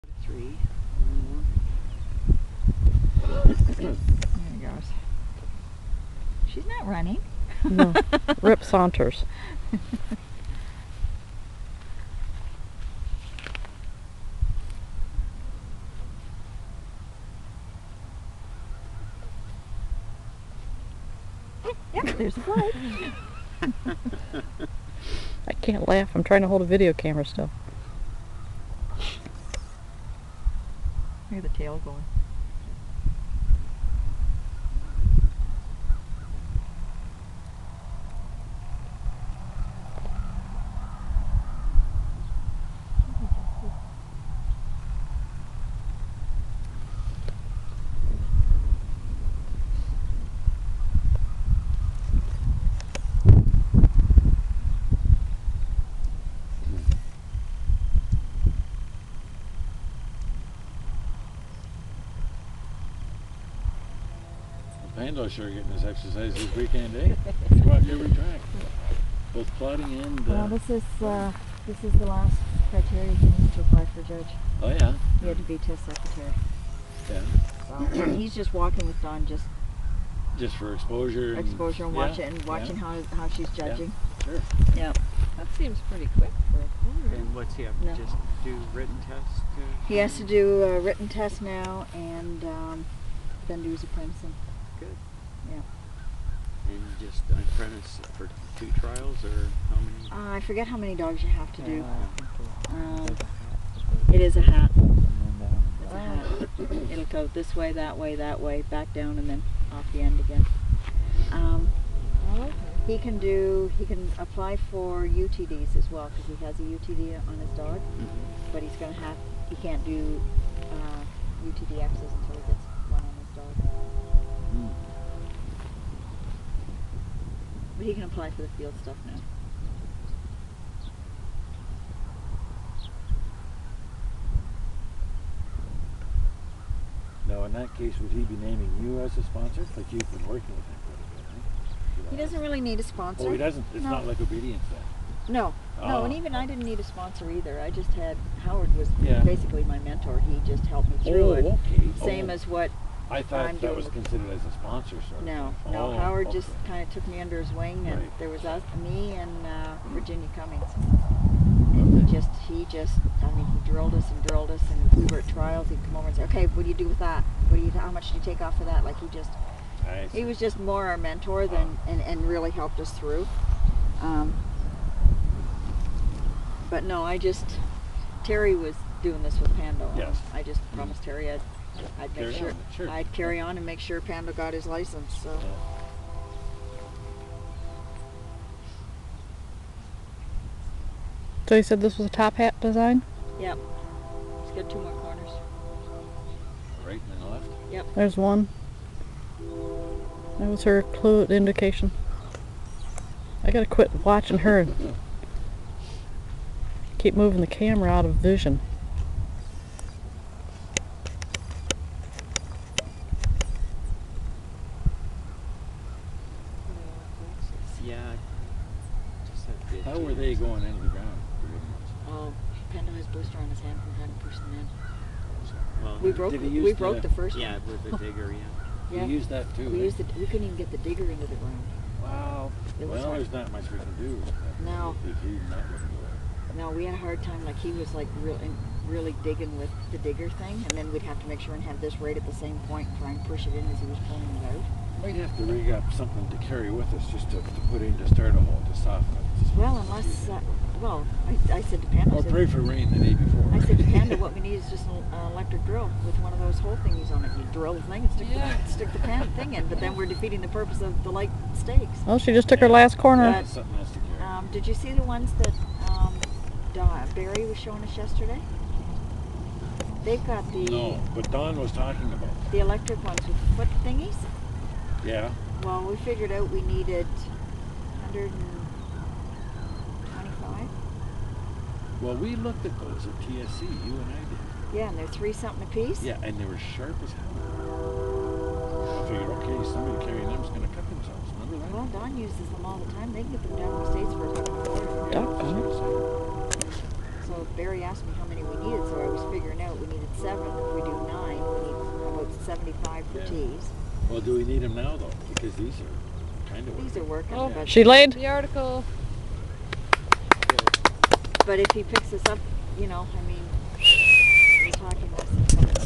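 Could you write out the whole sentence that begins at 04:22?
Well, she just took her last corner.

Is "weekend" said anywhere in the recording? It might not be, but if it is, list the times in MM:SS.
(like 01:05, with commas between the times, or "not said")
01:06.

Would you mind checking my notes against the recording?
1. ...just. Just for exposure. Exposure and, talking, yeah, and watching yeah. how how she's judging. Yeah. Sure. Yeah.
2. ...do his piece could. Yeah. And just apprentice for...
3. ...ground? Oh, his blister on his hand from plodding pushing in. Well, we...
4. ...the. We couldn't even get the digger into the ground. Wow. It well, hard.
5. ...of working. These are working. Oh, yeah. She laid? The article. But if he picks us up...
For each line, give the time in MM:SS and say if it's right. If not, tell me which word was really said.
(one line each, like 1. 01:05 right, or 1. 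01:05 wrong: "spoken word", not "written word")
1. 01:19 wrong: "watching", not "talking"
2. 01:33 wrong: "apprentice", not "piece"
3. 03:40 wrong: "having", not "plodding"
4. 03:49 right
5. 05:06 right.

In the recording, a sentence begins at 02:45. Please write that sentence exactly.
He'd come over and say, "Okay, what do you do with that?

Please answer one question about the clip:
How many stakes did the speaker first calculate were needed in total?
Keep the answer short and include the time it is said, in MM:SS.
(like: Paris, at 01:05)
125, at 04:38.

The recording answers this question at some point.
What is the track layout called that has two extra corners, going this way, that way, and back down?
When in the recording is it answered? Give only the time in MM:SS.
03:12.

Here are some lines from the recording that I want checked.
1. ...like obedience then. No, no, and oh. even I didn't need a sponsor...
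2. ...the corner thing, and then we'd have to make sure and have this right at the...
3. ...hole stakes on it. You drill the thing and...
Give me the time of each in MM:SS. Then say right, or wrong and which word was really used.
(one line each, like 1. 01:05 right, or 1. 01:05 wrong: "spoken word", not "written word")
1. 02:24 right
2. 03:59 wrong: "digger", not "corner"
3. 04:16 wrong: "thingies", not "stakes".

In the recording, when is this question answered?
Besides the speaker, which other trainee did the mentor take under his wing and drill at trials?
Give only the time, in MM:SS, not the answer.
02:39.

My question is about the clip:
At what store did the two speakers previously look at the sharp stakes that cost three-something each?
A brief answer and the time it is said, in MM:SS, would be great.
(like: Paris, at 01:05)
TSC, at 04:43.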